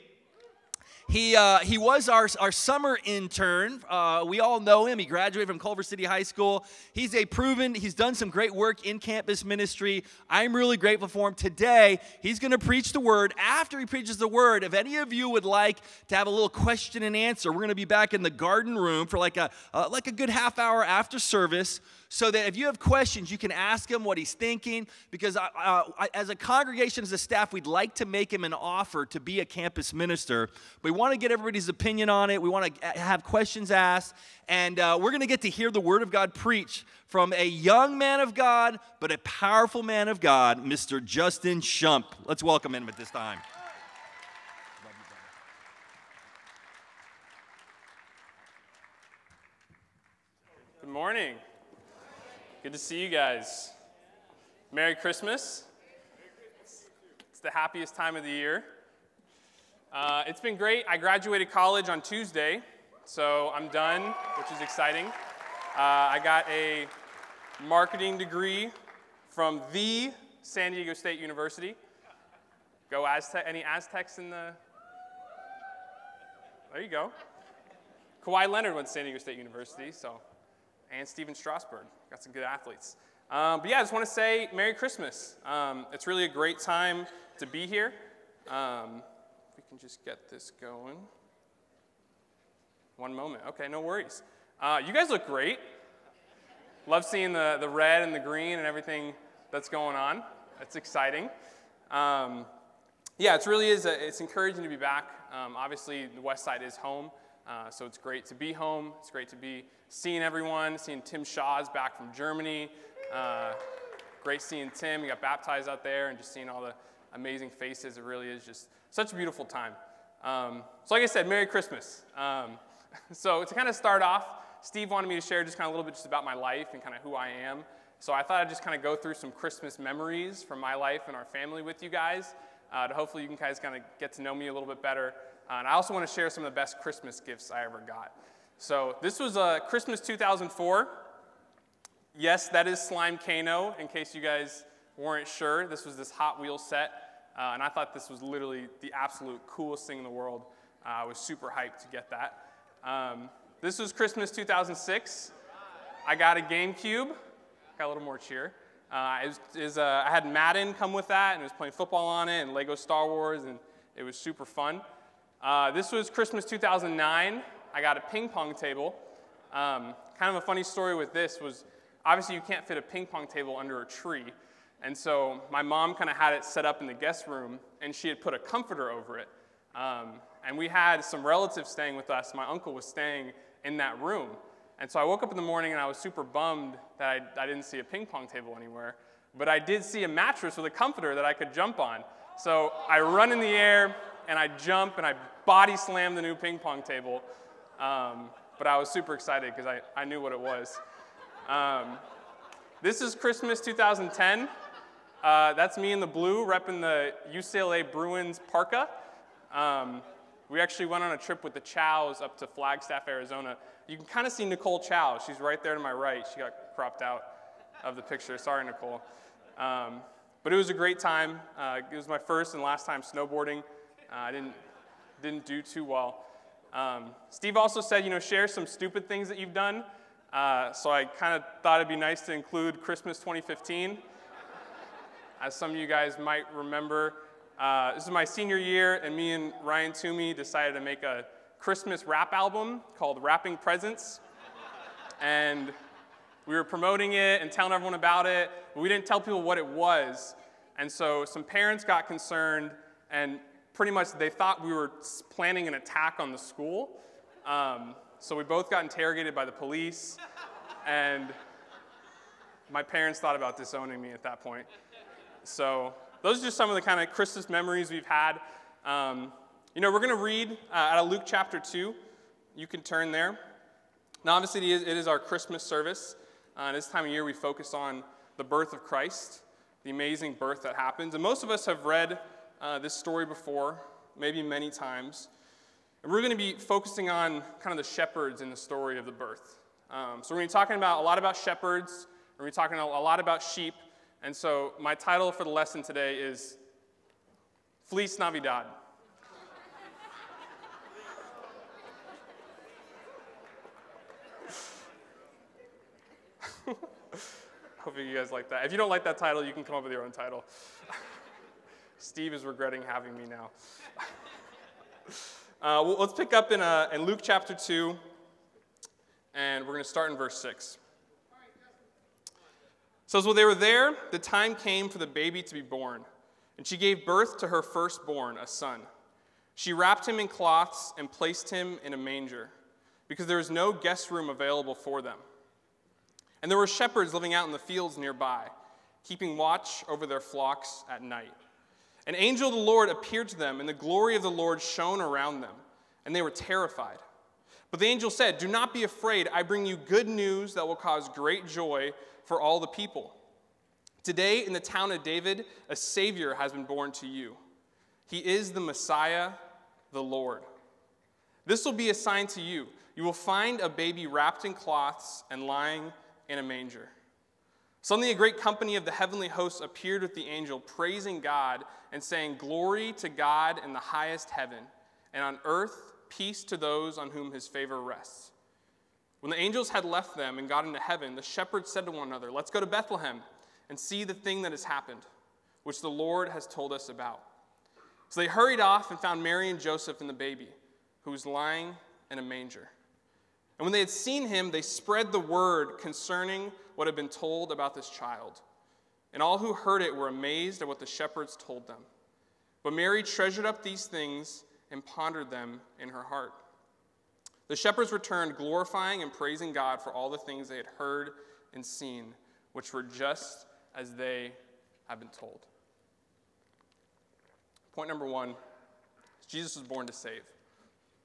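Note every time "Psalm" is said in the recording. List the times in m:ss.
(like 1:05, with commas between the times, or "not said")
not said.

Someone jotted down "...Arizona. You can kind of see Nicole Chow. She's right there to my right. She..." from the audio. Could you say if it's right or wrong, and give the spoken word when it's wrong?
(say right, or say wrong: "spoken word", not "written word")
right.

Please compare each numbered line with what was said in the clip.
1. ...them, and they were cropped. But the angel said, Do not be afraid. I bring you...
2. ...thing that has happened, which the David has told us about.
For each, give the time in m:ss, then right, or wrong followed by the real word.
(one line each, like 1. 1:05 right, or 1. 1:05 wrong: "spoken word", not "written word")
1. 5:45 wrong: "terrified", not "cropped"
2. 6:24 wrong: "Lord", not "David".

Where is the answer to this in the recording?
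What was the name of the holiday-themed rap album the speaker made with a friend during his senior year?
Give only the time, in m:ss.
4:03.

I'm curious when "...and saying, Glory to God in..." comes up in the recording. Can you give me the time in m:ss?
6:11.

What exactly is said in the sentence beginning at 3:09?
But I did see a mattress with a comforter that I could jump on.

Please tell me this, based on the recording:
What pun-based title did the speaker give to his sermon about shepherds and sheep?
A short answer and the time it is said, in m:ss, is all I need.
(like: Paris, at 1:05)
Fleece Navidad, at 4:57.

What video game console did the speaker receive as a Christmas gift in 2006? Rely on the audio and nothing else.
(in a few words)
GameCube.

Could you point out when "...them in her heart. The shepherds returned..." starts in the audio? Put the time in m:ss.
6:45.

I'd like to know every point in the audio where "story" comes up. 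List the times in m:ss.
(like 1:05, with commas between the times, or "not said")
2:50, 4:42, 4:48.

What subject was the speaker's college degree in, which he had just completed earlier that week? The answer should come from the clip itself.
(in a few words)
Marketing.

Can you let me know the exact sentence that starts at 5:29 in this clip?
She wrapped him in cloths and placed him in a manger, because there was no guest room available for them.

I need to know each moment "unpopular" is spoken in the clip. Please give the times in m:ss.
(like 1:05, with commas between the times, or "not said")
not said.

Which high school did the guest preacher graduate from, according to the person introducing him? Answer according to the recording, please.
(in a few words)
Culver City High School.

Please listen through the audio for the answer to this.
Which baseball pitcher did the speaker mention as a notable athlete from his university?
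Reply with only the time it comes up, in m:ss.
1:21.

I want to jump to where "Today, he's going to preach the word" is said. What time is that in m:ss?
0:11.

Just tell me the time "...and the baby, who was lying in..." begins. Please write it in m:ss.
6:30.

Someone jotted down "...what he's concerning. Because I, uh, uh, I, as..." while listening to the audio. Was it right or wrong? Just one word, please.
wrong.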